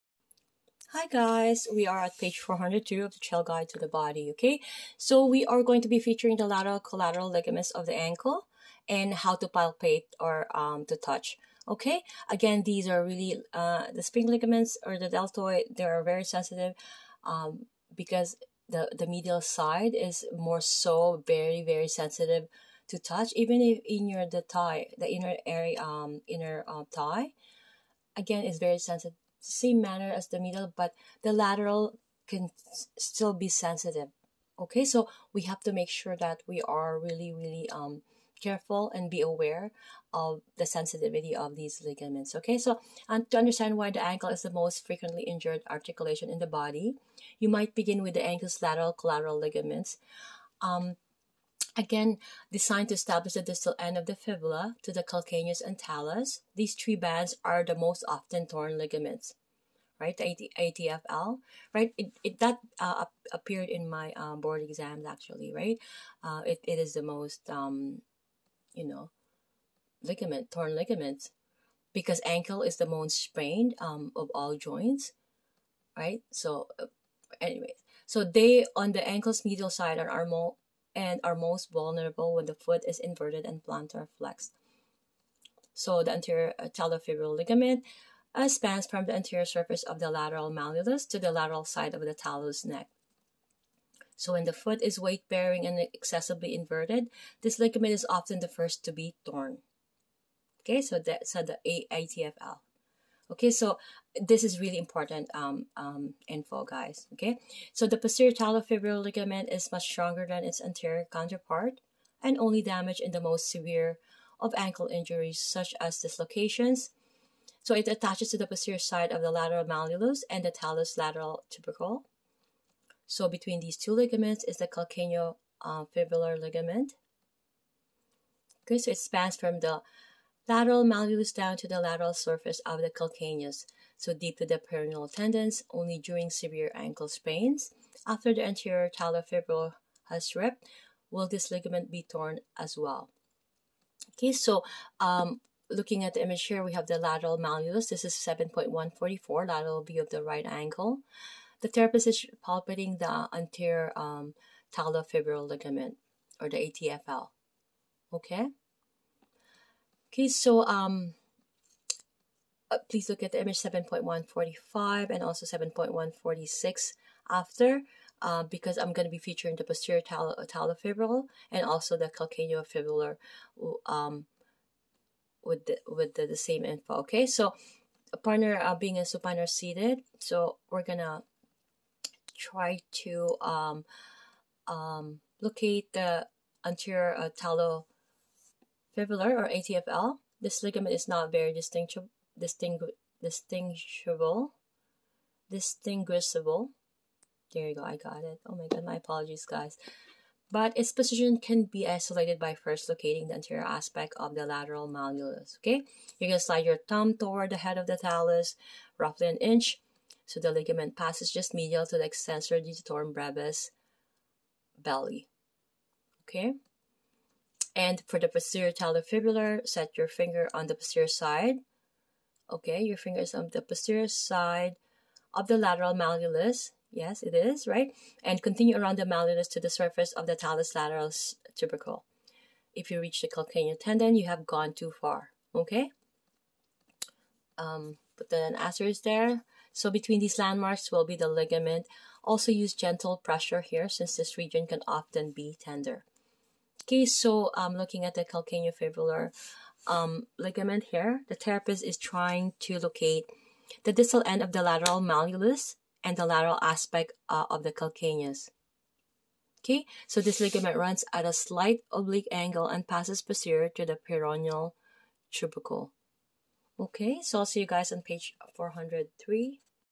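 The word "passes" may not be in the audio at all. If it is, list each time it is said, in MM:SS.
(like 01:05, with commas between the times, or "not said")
03:30, 04:22.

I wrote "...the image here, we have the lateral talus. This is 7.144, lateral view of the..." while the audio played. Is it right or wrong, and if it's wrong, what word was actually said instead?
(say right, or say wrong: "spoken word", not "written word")
wrong: "malleus", not "talus".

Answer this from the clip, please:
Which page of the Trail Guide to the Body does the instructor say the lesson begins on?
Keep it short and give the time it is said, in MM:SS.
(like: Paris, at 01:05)
402, at 00:02.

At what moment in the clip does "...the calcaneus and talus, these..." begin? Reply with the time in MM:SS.
00:54.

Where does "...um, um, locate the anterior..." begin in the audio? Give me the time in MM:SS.
03:03.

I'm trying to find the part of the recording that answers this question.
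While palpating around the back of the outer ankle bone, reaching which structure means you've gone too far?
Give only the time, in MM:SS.
03:53.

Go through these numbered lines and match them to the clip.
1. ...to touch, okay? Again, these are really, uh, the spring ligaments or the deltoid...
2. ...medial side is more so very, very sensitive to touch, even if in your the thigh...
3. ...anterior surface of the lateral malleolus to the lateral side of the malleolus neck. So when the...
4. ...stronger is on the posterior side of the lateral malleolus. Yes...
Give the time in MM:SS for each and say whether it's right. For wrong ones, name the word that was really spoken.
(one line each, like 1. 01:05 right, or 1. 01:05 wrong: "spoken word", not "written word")
1. 00:10 right
2. 00:19 right
3. 01:29 wrong: "talus", not "malleolus"
4. 03:42 wrong: "finger", not "stronger".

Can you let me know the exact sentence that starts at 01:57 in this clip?
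So it attaches to the posterior side of the lateral malleolus and the talus lateral tubercle.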